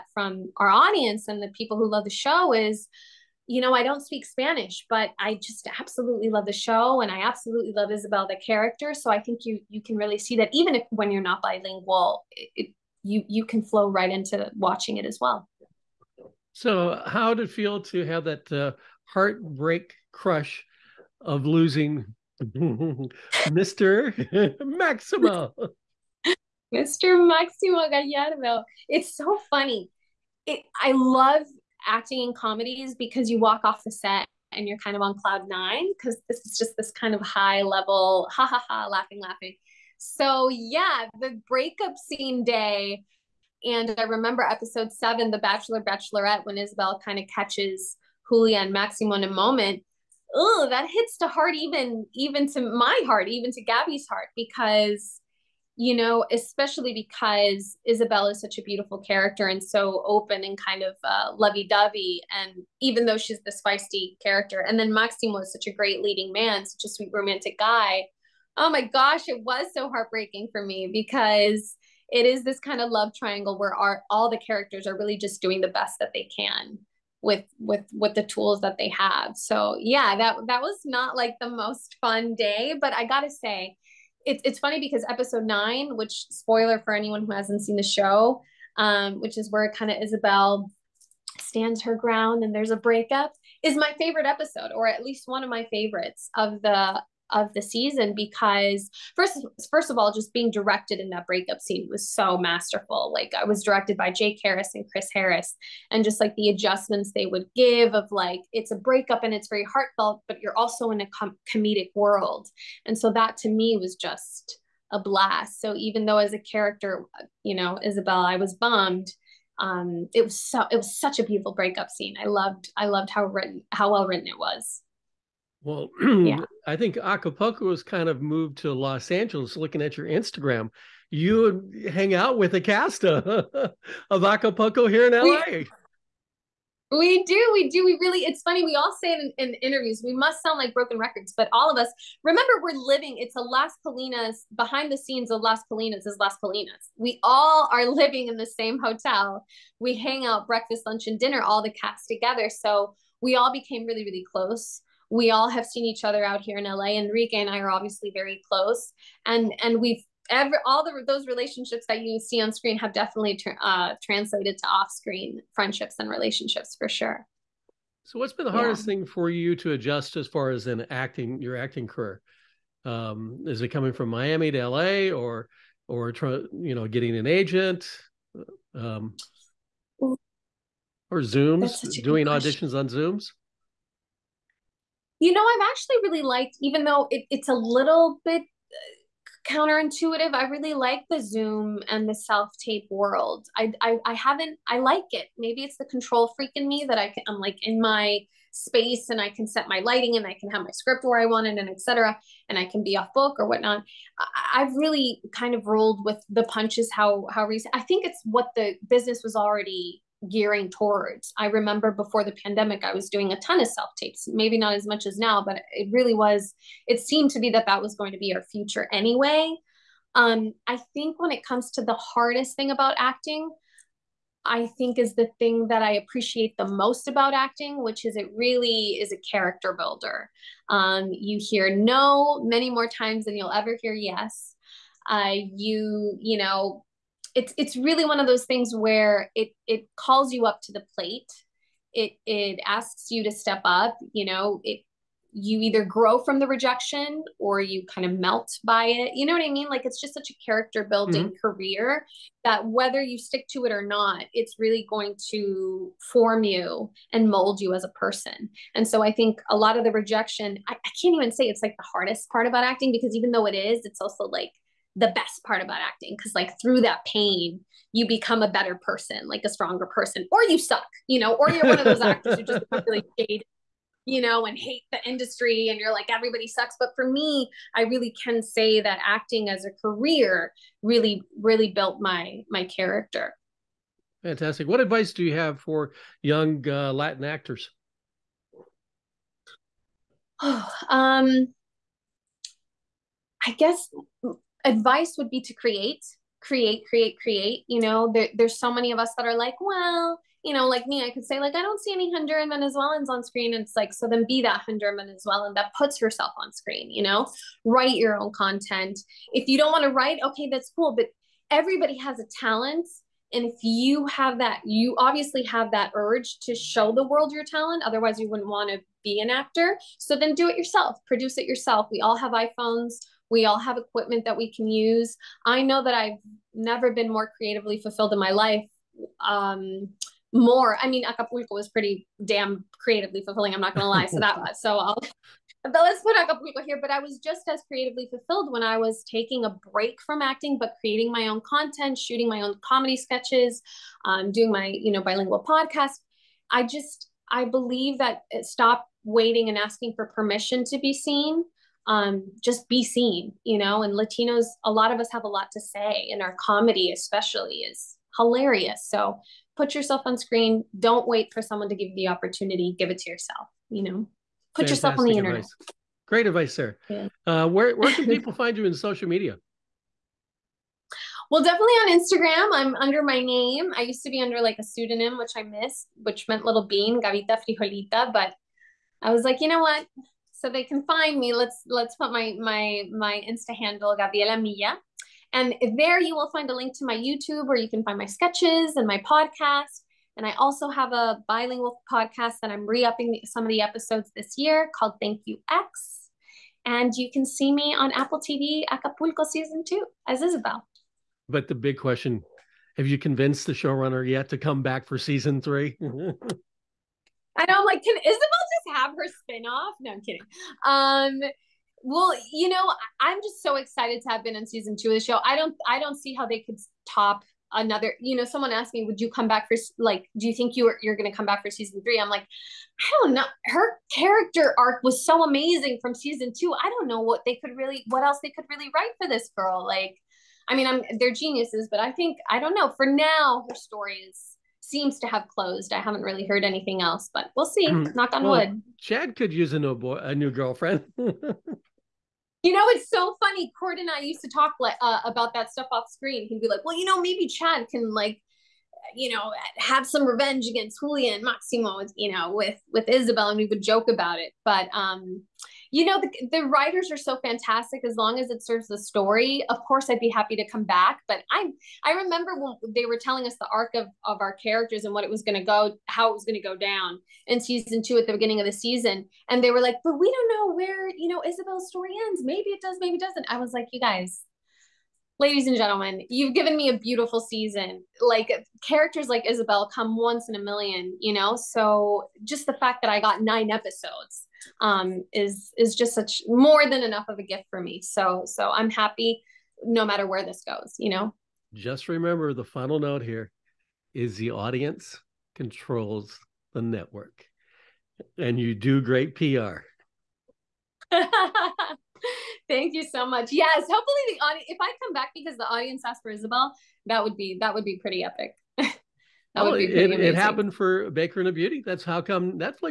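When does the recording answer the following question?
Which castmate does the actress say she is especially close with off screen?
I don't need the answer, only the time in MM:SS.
02:36.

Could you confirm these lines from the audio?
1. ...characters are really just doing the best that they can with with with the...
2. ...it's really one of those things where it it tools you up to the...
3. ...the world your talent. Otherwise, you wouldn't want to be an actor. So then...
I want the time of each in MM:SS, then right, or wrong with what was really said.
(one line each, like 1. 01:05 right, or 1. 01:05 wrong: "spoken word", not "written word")
1. 01:14 right
2. 03:57 wrong: "calls", not "tools"
3. 05:16 right.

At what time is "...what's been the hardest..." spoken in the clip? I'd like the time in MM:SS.
02:48.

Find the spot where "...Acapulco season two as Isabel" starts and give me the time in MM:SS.
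06:38.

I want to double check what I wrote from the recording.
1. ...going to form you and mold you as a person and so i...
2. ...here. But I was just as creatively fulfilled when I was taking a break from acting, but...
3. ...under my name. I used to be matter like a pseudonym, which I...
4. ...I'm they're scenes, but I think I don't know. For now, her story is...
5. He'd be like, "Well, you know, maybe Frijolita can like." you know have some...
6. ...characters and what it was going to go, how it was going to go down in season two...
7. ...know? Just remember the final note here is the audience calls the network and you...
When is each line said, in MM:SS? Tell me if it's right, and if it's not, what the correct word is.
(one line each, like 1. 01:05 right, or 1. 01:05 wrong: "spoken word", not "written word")
1. 04:14 right
2. 05:36 right
3. 06:12 wrong: "under", not "matter"
4. 07:10 wrong: "geniuses", not "scenes"
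5. 07:26 wrong: "Chad", not "Frijolita"
6. 07:44 right
7. 08:10 wrong: "controls", not "calls".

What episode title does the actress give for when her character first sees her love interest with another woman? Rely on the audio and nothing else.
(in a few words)
The Bachelor Bachelorette.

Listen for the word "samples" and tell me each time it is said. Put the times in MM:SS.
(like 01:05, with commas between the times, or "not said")
not said.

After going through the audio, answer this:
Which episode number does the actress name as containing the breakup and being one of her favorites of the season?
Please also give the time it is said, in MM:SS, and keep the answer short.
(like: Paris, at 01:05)
9, at 01:25.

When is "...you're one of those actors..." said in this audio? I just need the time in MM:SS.
04:31.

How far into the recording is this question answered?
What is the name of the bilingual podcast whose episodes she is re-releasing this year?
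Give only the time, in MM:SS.
06:35.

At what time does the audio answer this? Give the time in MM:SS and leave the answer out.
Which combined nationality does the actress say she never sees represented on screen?
05:04.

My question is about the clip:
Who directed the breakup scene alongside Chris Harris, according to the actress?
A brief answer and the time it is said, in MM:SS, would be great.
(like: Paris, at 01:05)
Jake Harris, at 01:44.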